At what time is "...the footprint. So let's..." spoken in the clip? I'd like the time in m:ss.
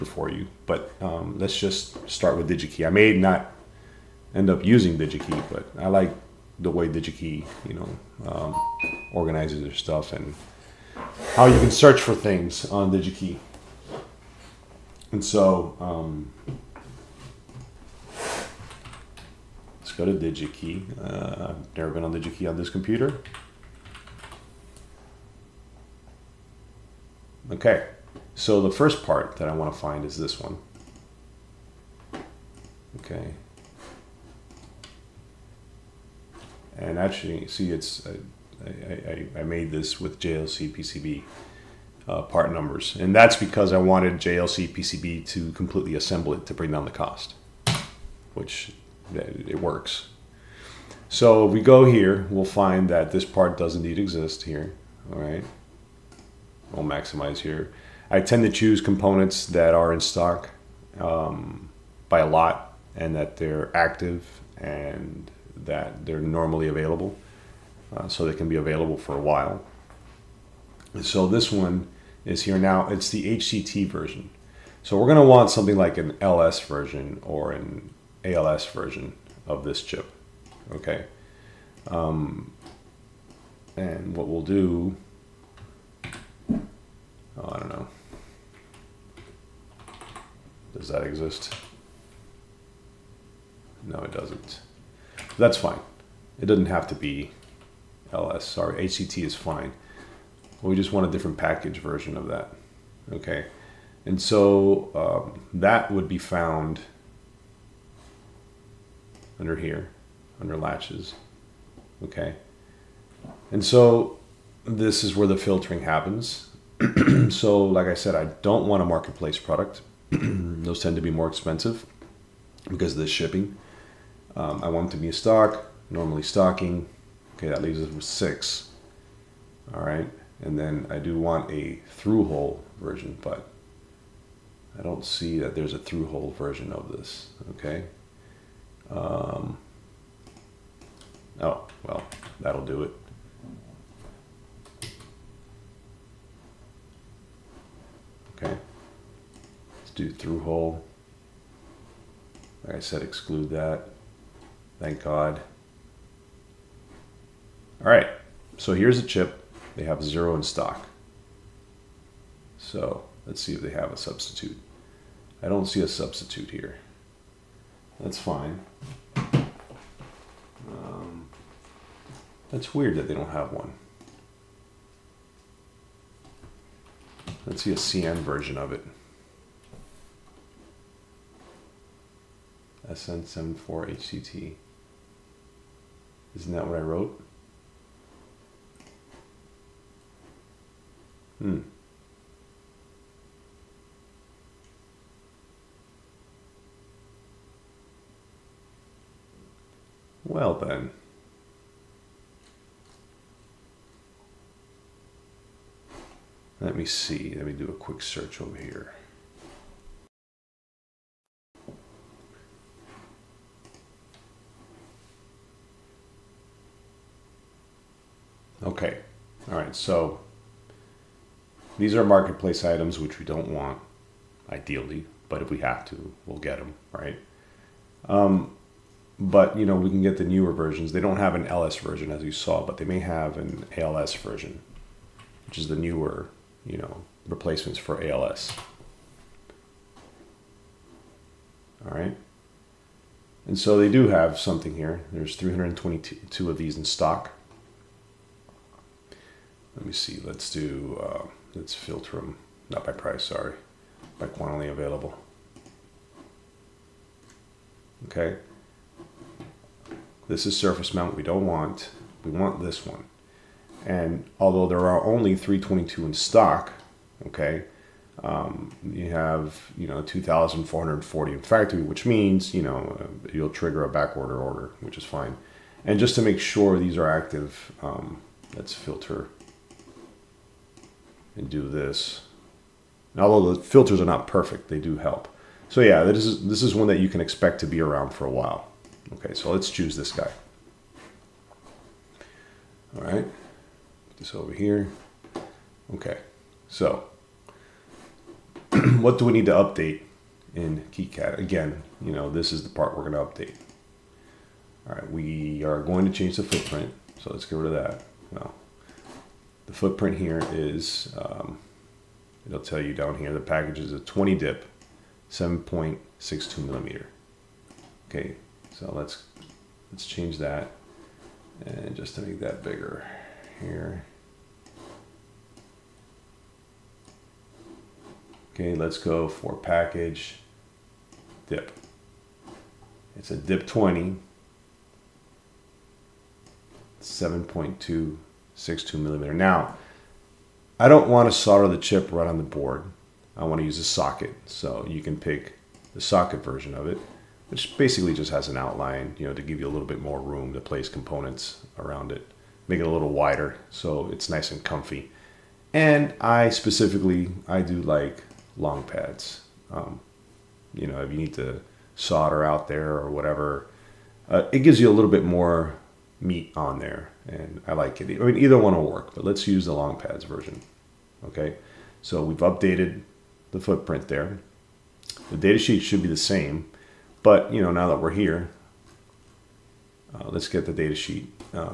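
5:06.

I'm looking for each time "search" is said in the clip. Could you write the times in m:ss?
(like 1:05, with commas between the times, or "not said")
0:11, 3:27.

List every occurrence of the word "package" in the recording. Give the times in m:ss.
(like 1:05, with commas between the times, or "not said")
1:41, 5:13, 5:29.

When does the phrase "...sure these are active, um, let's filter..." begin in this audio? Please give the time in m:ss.
4:36.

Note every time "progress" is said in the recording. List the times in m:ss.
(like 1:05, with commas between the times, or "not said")
not said.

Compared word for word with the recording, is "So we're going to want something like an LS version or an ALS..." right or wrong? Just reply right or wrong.
right.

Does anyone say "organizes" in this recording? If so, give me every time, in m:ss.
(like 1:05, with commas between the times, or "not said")
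0:09.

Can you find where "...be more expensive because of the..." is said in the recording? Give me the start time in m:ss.
2:01.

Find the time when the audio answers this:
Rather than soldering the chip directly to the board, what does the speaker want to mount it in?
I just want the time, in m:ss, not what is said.
5:43.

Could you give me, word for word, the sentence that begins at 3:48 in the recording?
Um, but you know we can get the newer versions.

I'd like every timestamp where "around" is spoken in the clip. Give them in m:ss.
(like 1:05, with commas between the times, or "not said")
4:47, 5:51.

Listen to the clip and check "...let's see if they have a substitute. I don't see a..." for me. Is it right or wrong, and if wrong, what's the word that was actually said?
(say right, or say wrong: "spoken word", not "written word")
right.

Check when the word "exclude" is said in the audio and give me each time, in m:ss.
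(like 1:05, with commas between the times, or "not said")
2:33.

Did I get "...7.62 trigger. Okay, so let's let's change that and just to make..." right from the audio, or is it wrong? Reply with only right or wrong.
wrong.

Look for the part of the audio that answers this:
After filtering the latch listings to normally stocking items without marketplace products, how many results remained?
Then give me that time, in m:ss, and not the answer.
2:08.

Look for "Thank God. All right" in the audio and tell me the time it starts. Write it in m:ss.
2:34.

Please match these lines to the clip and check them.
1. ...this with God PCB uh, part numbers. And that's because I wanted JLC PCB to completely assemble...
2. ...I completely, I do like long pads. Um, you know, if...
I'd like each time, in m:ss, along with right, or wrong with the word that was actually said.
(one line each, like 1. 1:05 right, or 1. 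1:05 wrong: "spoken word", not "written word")
1. 0:39 wrong: "JLC", not "God"
2. 5:56 wrong: "specifically", not "completely".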